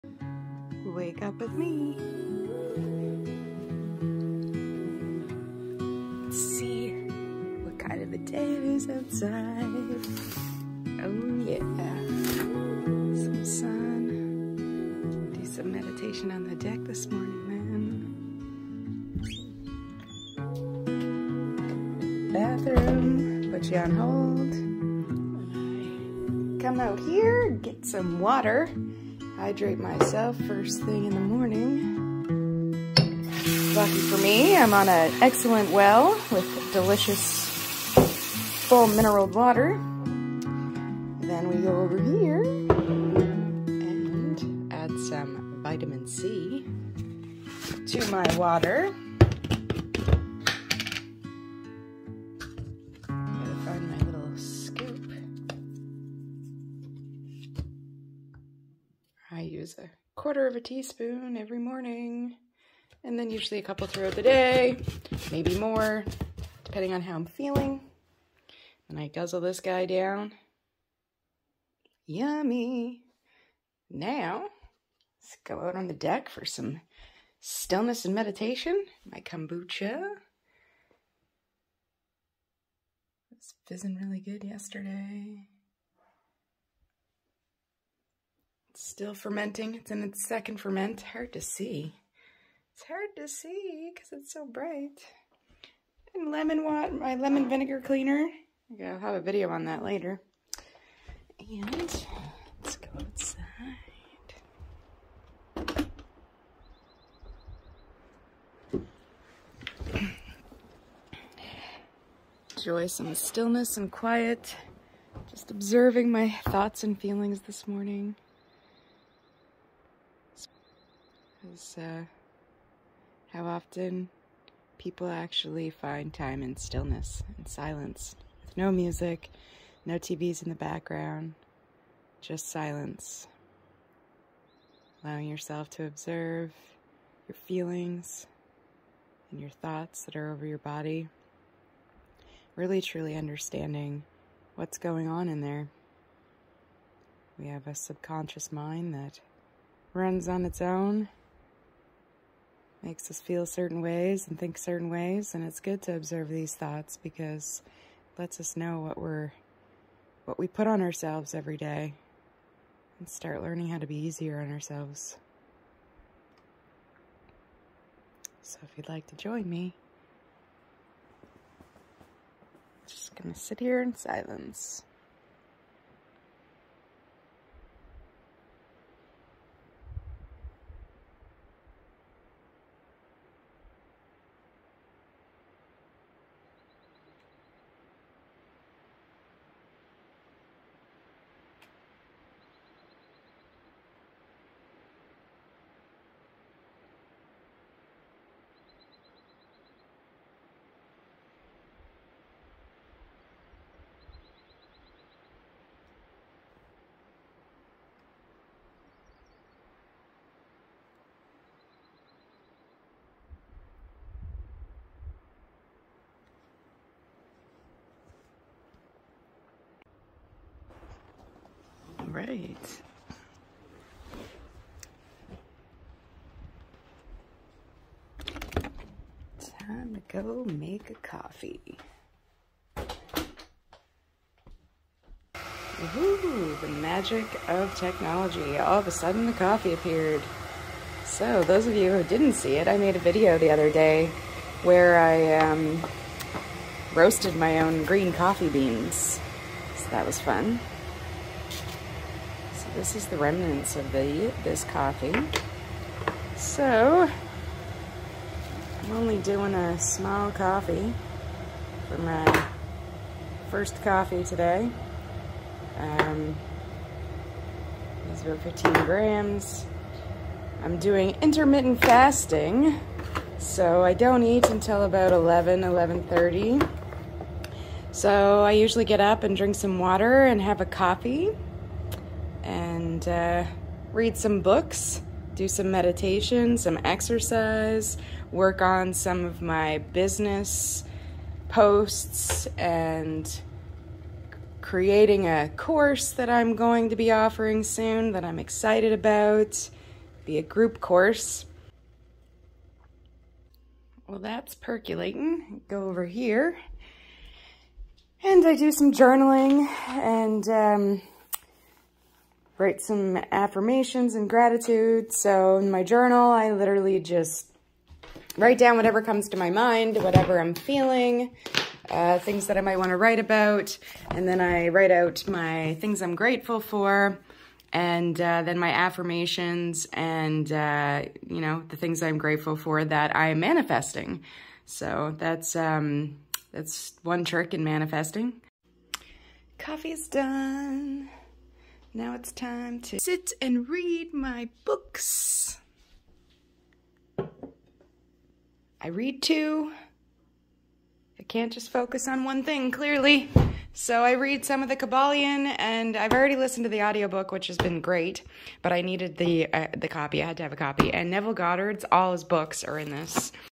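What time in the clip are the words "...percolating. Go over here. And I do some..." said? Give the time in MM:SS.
05:04.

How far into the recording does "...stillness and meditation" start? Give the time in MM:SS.
01:17.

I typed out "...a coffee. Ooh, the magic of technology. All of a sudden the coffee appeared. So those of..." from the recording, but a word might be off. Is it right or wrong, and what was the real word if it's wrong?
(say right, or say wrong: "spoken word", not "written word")
right.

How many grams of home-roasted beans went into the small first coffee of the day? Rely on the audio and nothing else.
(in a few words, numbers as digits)
15.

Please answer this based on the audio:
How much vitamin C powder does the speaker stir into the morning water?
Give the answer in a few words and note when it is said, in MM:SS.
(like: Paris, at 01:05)
a quarter of a teaspoon, at 00:59.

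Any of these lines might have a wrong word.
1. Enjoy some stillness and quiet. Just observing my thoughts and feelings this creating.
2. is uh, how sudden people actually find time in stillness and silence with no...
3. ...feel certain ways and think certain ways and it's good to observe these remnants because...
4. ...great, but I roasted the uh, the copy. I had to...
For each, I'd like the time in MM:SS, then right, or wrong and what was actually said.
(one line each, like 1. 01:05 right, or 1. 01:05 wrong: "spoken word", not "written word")
1. 01:52 wrong: "morning", not "creating"
2. 02:01 wrong: "often", not "sudden"
3. 02:33 wrong: "thoughts", not "remnants"
4. 05:57 wrong: "needed", not "roasted".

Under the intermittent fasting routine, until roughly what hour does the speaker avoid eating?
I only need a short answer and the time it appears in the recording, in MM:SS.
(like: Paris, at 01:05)
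11, at 04:35.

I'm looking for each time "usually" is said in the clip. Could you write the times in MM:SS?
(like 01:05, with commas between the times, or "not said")
01:03, 04:38.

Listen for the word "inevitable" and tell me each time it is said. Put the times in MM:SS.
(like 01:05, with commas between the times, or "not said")
not said.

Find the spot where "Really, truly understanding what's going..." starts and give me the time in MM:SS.
02:22.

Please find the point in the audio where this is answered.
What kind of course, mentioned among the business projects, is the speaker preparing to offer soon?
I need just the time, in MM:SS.
05:00.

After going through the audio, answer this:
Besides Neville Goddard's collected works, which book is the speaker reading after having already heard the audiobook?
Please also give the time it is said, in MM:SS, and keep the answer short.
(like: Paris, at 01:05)
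The Kybalion, at 05:54.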